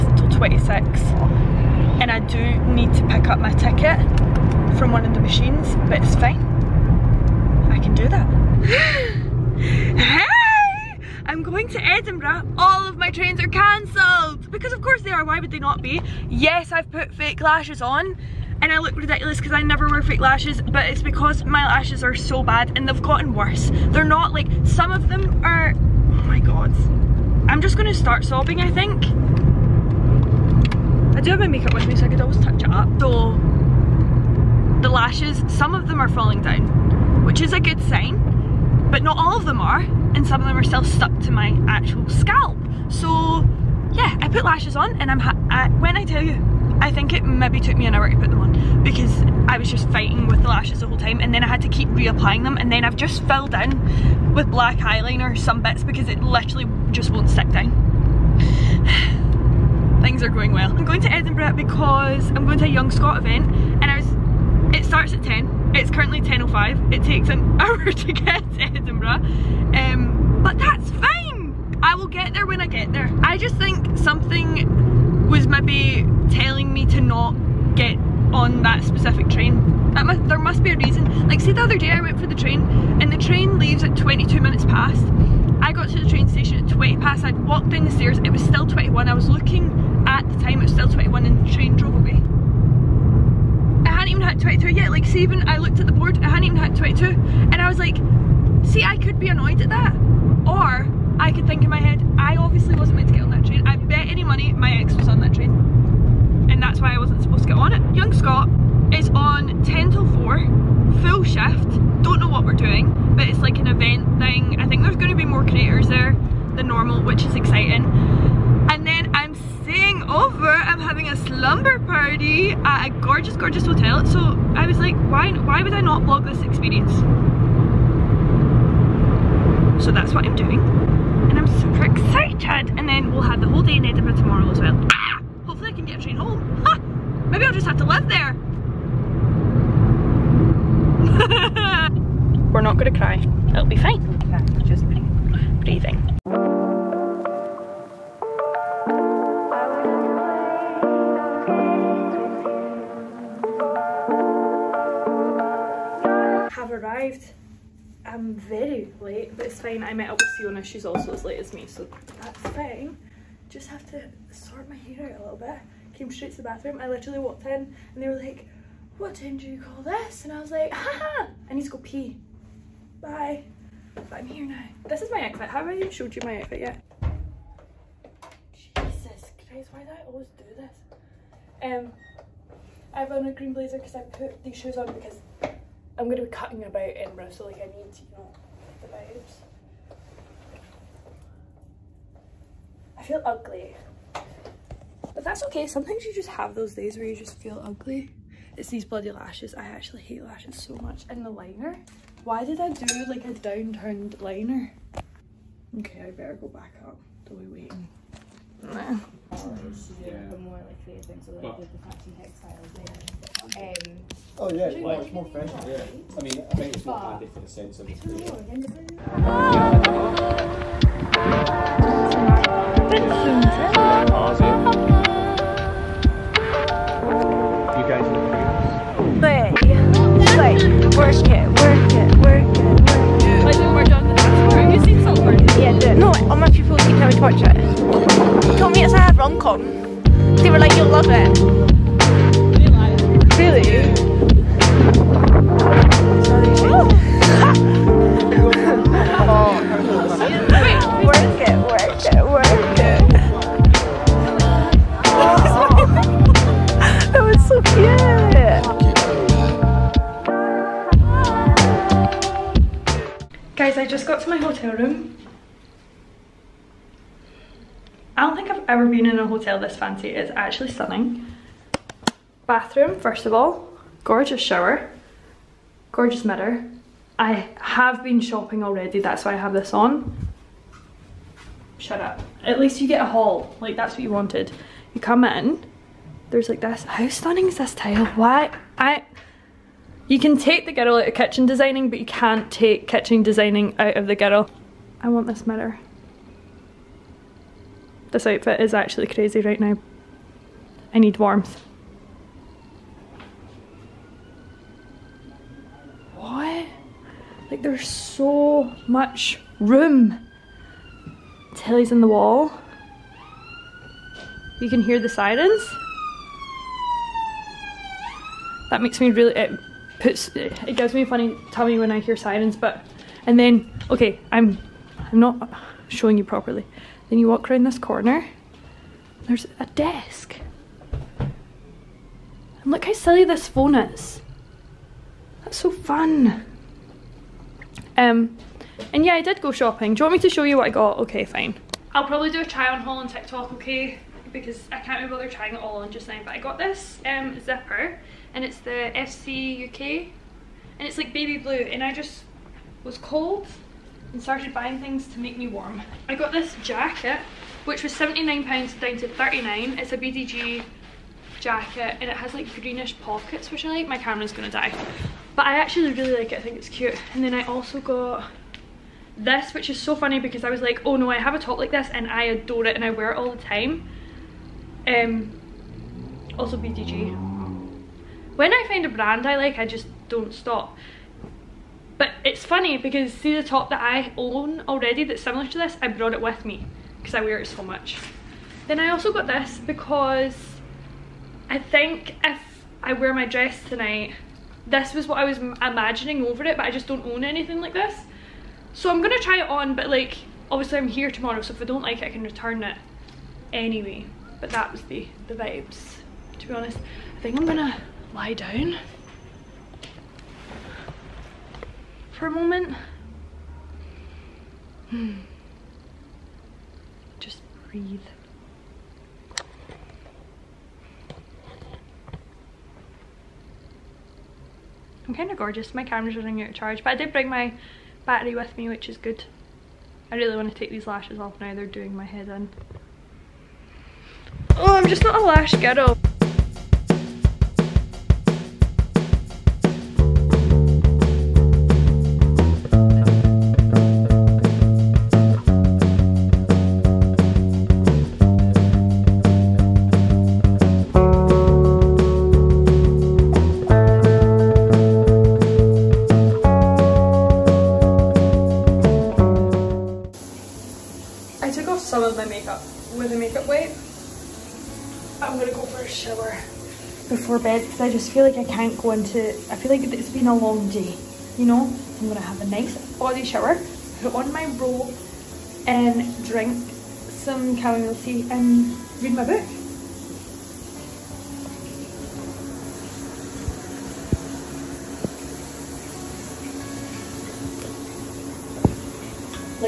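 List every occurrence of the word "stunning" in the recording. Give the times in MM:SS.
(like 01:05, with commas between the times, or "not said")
04:30, 04:47.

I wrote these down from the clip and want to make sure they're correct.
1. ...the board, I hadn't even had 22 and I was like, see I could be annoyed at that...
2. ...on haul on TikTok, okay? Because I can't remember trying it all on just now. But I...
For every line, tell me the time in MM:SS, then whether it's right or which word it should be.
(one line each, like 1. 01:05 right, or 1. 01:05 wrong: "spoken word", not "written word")
1. 01:35 right
2. 05:42 right.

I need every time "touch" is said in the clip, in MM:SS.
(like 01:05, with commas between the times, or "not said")
00:32.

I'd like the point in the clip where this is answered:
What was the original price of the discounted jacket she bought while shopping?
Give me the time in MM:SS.
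05:57.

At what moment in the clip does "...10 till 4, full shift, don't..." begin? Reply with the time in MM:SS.
01:49.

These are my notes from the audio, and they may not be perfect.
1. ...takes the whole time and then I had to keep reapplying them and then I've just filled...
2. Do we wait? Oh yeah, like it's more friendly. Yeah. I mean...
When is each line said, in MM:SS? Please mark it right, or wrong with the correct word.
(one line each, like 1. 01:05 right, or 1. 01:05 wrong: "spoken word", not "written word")
1. 00:50 wrong: "lashes", not "takes"
2. 03:27 right.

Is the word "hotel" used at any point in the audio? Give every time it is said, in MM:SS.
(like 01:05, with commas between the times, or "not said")
02:03, 04:29.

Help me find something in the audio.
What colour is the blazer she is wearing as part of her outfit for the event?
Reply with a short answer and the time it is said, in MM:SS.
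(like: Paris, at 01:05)
Green, at 03:03.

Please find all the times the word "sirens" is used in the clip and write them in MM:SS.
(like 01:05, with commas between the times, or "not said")
05:15, 05:22.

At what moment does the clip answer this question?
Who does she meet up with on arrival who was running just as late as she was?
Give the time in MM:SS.
02:40.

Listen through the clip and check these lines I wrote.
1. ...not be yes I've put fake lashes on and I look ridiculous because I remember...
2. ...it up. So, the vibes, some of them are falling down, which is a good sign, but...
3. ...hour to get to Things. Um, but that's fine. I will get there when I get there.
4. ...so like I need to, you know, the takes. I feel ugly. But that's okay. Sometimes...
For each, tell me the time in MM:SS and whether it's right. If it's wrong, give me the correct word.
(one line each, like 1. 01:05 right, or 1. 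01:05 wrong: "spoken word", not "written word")
1. 00:15 wrong: "never", not "remember"
2. 00:32 wrong: "lashes", not "vibes"
3. 01:07 wrong: "Edinburgh", not "Things"
4. 03:07 wrong: "vibes", not "takes".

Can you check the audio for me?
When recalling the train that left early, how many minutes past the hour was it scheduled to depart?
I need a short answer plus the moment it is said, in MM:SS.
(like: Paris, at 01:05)
22, at 01:23.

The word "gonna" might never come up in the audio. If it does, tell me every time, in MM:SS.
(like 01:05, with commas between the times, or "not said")
00:27, 02:22, 06:04, 06:39, 06:47, 07:45, 07:52.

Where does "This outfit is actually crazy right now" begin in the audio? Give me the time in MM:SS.
04:58.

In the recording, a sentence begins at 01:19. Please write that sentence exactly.
That there must be a reason.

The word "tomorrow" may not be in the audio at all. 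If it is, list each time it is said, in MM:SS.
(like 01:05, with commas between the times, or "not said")
02:14, 06:41.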